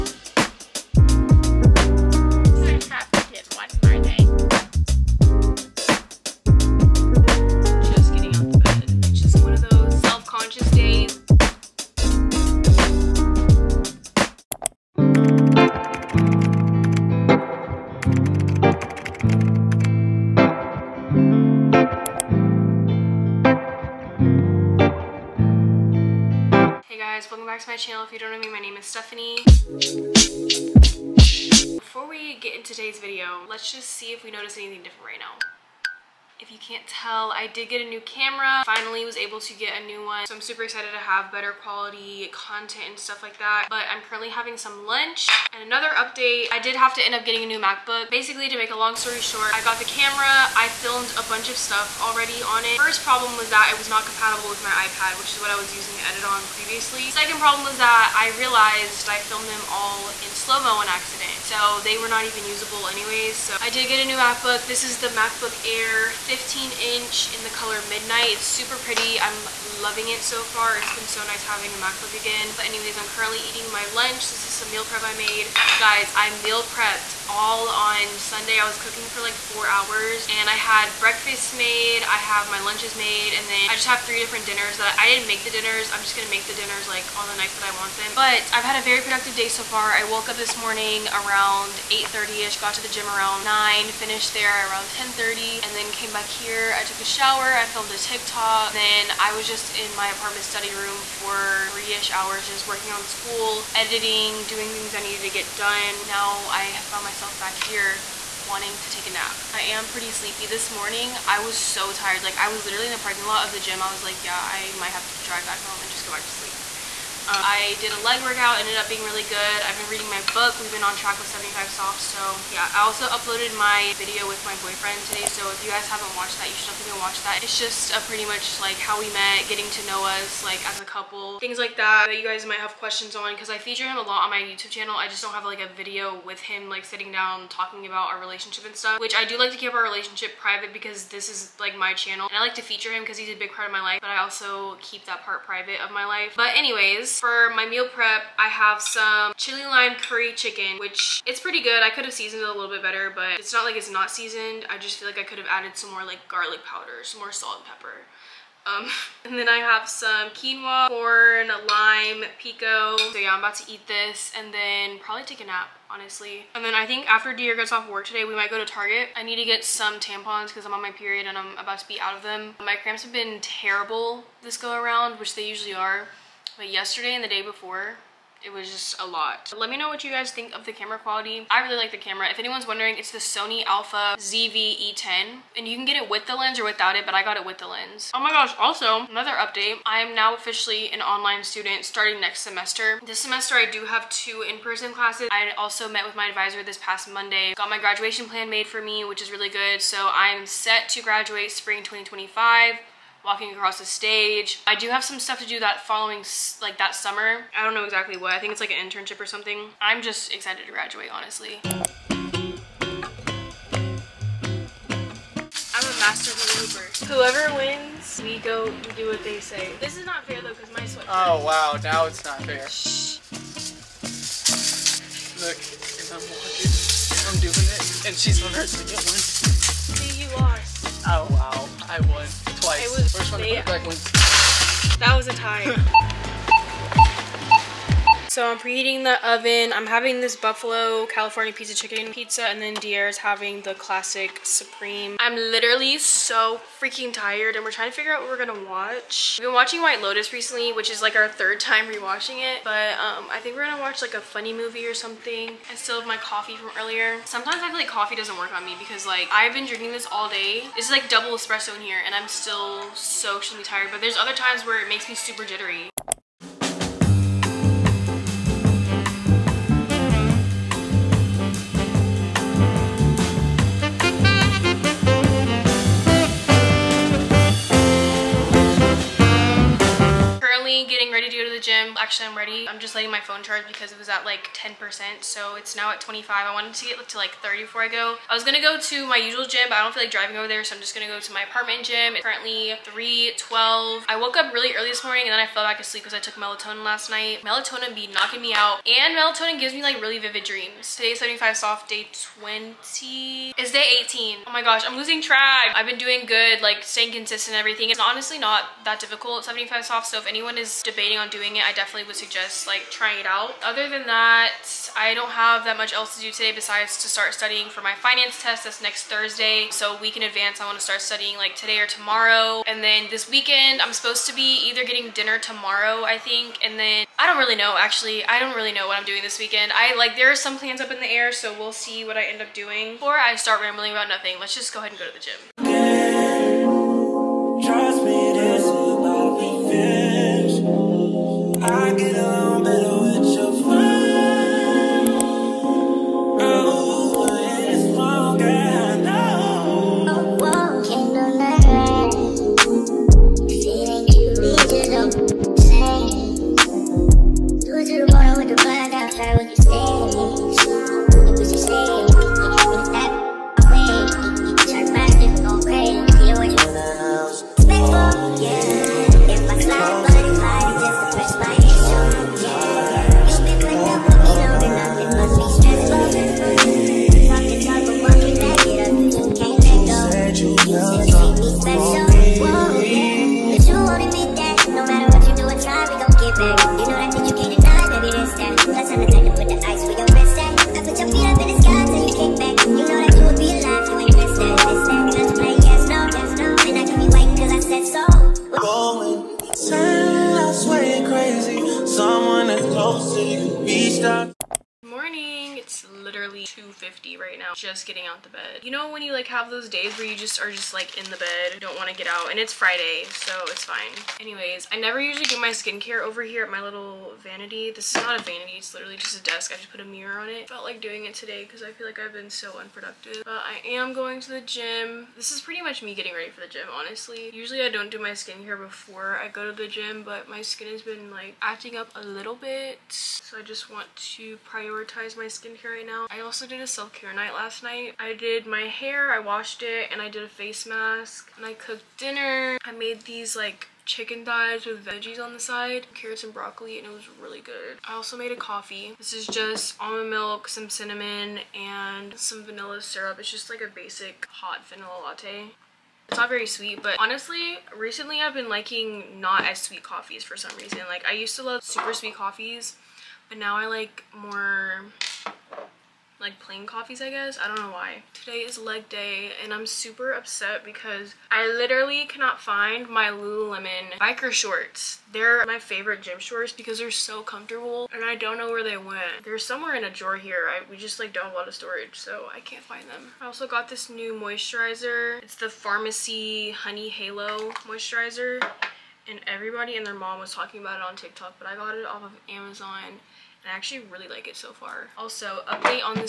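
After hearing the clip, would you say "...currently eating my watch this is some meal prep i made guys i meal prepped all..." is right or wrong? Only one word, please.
wrong.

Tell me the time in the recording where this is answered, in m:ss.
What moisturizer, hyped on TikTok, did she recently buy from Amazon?
8:05.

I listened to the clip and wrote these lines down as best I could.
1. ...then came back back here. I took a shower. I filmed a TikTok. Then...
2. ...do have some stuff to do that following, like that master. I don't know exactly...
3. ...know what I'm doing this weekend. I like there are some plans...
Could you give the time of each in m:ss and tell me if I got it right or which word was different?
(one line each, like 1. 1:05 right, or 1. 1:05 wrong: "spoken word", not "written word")
1. 1:35 right
2. 3:24 wrong: "summer", not "master"
3. 5:28 right.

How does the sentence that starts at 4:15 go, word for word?
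I still have my coffee from earlier.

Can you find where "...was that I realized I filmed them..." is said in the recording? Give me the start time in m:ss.
0:57.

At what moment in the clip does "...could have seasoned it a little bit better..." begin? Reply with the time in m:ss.
2:31.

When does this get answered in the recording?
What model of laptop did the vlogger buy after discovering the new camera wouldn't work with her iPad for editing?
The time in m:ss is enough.
1:05.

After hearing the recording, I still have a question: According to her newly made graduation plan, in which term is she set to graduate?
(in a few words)
Spring 2025.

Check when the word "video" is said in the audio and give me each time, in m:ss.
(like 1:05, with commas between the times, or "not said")
0:32, 2:03, 2:15.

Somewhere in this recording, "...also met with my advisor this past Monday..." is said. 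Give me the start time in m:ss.
3:15.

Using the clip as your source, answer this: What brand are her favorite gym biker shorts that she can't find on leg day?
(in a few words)
Lululemon.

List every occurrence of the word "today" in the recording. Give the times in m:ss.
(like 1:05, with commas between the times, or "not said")
0:32, 2:05, 2:48, 5:00, 5:16, 5:21, 7:01, 7:48.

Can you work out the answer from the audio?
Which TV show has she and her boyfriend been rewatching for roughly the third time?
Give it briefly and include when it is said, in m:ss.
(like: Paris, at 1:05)
White Lotus, at 4:09.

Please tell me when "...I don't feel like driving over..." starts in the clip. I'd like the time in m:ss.
4:49.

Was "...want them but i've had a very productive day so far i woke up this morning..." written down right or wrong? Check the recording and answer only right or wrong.
right.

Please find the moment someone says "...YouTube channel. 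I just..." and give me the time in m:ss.
2:14.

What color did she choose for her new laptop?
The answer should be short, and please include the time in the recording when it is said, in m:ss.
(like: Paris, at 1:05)
Midnight, at 1:07.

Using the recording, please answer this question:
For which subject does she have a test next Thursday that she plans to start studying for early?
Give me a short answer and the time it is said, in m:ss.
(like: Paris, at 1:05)
Finance, at 5:17.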